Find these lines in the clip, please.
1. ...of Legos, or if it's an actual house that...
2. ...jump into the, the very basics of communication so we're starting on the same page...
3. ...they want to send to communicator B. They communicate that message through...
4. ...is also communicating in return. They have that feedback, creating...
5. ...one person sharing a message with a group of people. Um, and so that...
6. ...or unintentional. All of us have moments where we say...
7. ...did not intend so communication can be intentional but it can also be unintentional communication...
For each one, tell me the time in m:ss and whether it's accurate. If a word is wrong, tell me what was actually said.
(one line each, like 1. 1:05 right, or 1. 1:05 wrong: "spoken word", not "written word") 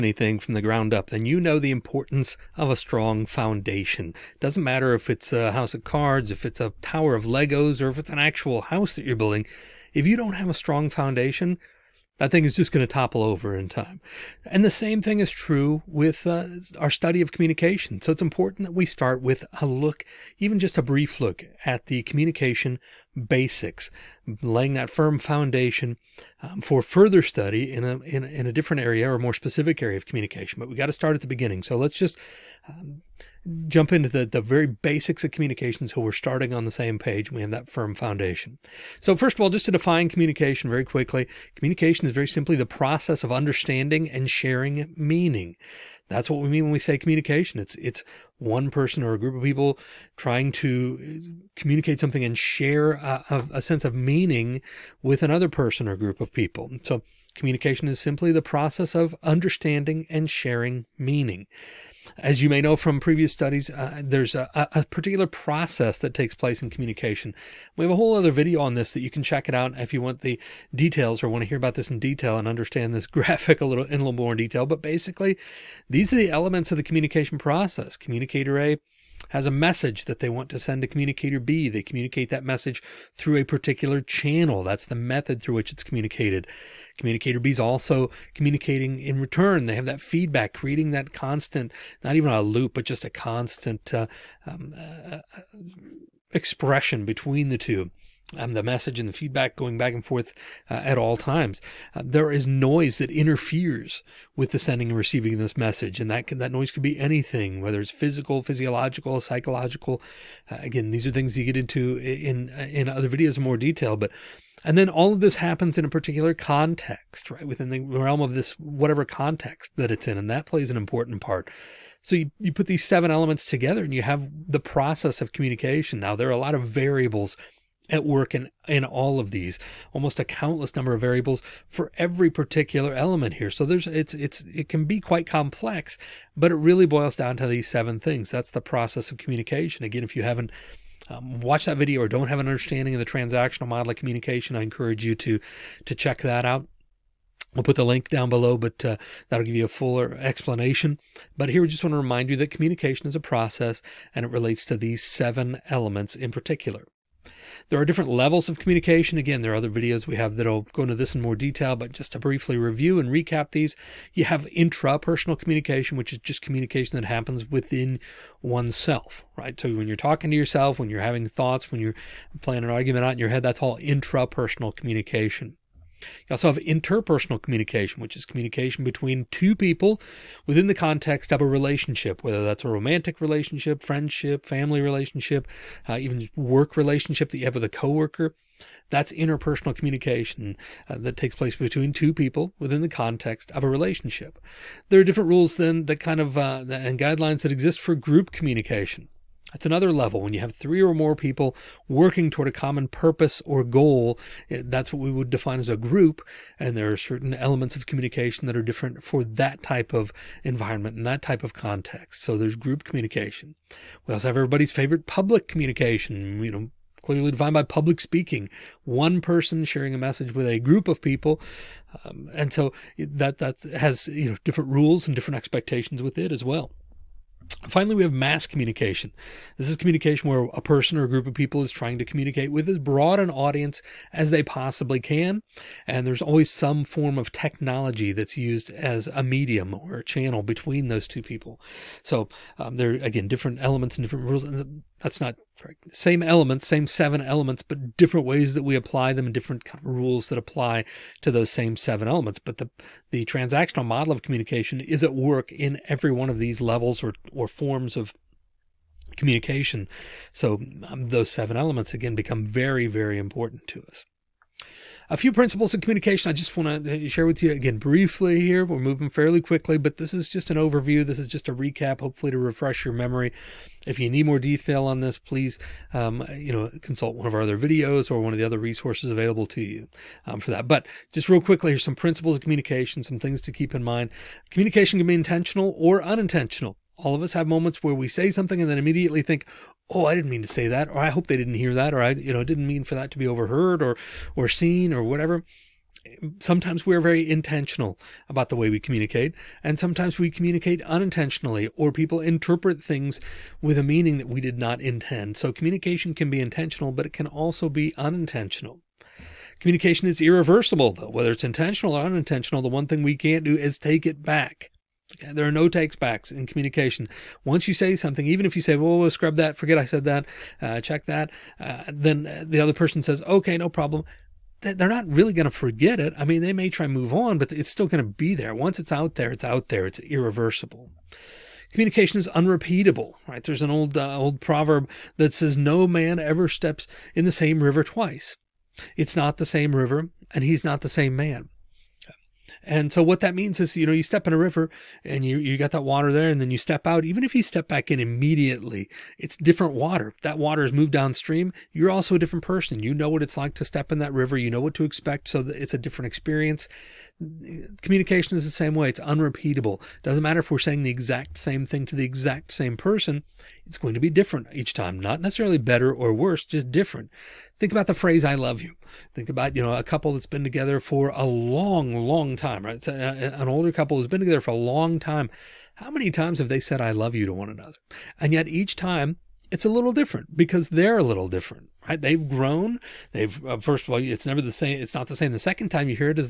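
1. 0:07 right
2. 0:33 right
3. 1:20 right
4. 1:27 right
5. 3:38 right
6. 4:45 right
7. 5:04 right.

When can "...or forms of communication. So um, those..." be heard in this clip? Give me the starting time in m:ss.
4:17.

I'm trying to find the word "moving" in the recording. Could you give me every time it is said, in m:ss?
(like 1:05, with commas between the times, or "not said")
4:28.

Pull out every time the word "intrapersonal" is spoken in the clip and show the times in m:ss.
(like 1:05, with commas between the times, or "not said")
2:44, 2:53.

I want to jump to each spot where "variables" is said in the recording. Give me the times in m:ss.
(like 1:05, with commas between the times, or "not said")
2:06, 2:11.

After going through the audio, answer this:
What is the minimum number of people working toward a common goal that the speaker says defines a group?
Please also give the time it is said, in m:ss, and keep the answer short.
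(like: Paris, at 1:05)
3, at 3:20.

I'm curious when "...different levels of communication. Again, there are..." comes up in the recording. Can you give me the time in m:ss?
2:37.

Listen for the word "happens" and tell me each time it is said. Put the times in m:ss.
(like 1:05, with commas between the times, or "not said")
1:55, 2:47.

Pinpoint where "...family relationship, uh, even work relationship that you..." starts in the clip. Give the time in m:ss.
3:04.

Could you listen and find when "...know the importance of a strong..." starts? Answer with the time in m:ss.
0:01.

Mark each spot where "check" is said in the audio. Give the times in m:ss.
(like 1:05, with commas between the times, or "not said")
1:09, 2:25, 5:20.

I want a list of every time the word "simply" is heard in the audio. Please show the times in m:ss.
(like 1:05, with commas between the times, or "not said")
0:42, 0:57.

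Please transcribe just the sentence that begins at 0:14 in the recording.
And the same thing is true with uh, our study of communication.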